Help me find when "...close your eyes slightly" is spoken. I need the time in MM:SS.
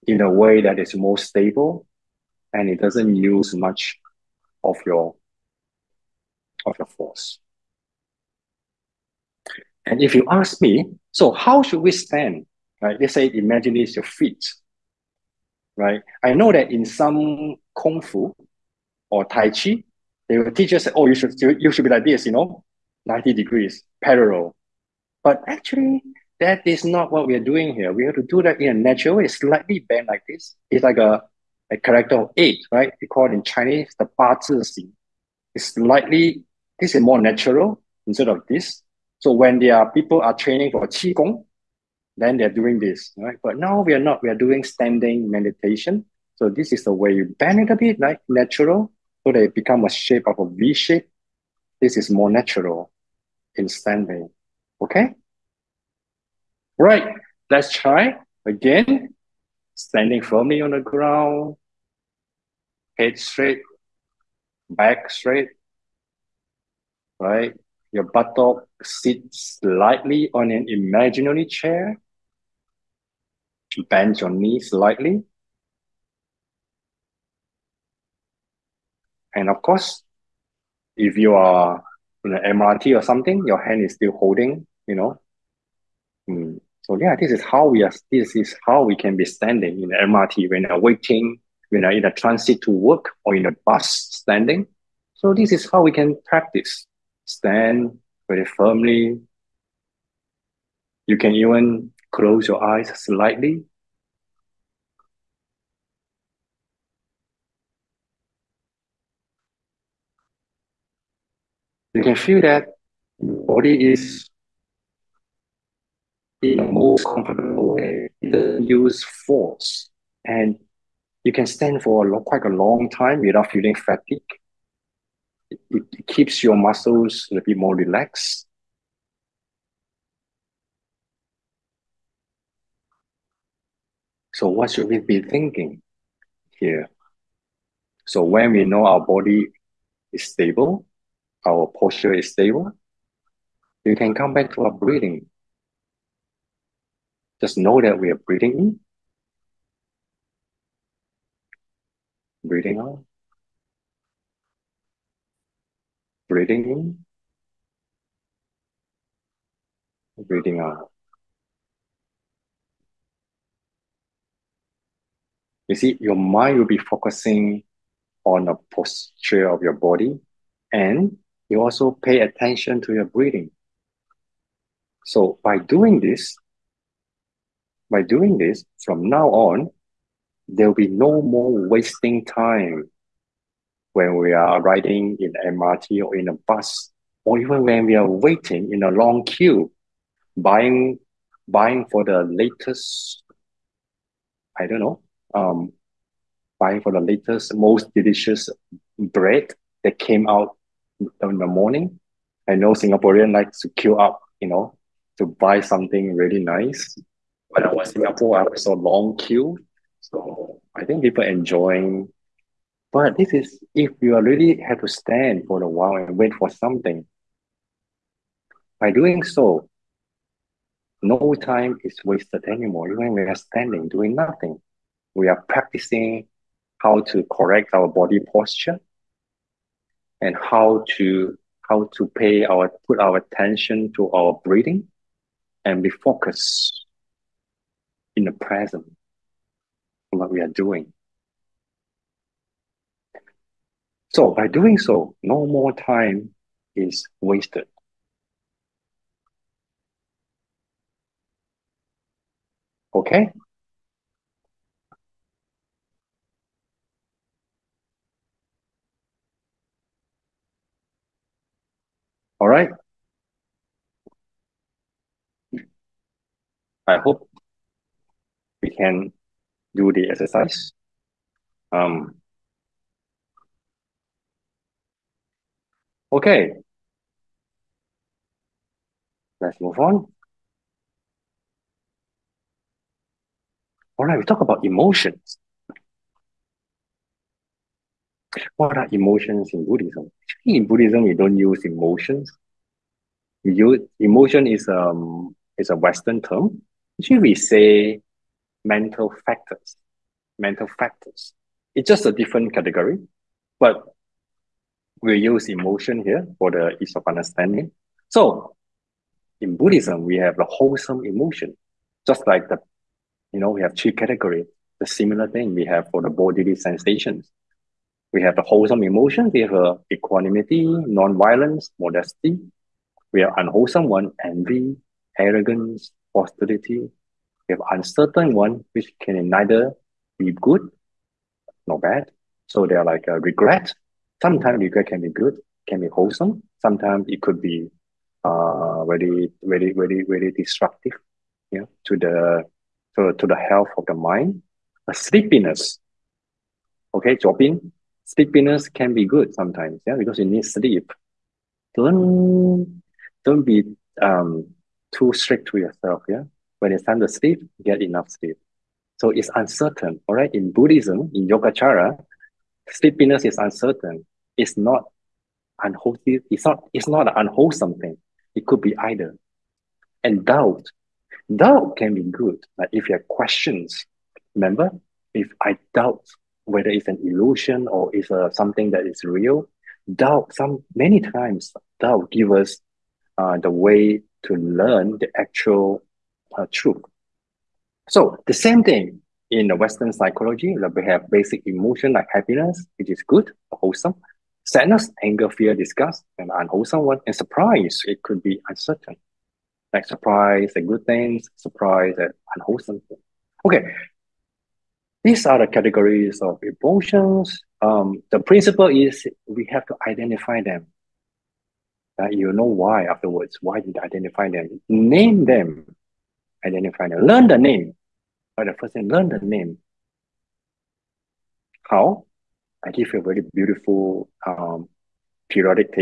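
01:42.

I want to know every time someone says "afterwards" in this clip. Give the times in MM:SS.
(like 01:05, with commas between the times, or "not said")
06:52.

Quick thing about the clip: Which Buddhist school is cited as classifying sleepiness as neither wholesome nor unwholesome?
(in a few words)
Yogacara.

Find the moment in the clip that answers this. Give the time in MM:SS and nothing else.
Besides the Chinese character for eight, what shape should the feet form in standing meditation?
00:50.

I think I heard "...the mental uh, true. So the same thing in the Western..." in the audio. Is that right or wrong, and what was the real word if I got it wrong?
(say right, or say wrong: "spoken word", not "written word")
wrong: "actual", not "mental".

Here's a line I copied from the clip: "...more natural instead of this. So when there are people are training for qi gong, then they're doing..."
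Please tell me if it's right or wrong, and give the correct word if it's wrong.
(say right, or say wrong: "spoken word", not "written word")
right.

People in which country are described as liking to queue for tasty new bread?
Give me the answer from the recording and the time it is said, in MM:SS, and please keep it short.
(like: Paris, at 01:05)
Singapore, at 03:22.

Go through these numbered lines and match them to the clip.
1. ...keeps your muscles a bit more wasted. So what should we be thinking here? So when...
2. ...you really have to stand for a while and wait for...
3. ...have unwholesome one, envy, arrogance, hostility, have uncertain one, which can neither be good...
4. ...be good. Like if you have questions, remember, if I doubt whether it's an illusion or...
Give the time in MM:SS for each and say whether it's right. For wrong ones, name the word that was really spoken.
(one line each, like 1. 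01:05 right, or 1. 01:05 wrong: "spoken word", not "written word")
1. 02:06 wrong: "relaxed", not "wasted"
2. 03:33 right
3. 05:23 right
4. 06:11 right.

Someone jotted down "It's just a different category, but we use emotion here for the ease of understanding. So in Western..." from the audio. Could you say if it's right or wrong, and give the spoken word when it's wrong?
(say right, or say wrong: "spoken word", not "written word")
wrong: "Buddhism", not "Western".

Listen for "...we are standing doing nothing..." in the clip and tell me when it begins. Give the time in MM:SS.
03:43.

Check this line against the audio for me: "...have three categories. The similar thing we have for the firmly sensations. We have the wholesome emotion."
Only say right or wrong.
wrong.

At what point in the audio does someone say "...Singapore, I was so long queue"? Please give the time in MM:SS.
03:28.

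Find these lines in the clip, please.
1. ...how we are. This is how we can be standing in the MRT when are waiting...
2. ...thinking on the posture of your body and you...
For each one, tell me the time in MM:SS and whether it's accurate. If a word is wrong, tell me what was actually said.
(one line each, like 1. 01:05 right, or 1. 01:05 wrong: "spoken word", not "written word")
1. 01:27 right
2. 02:46 wrong: "focusing", not "thinking".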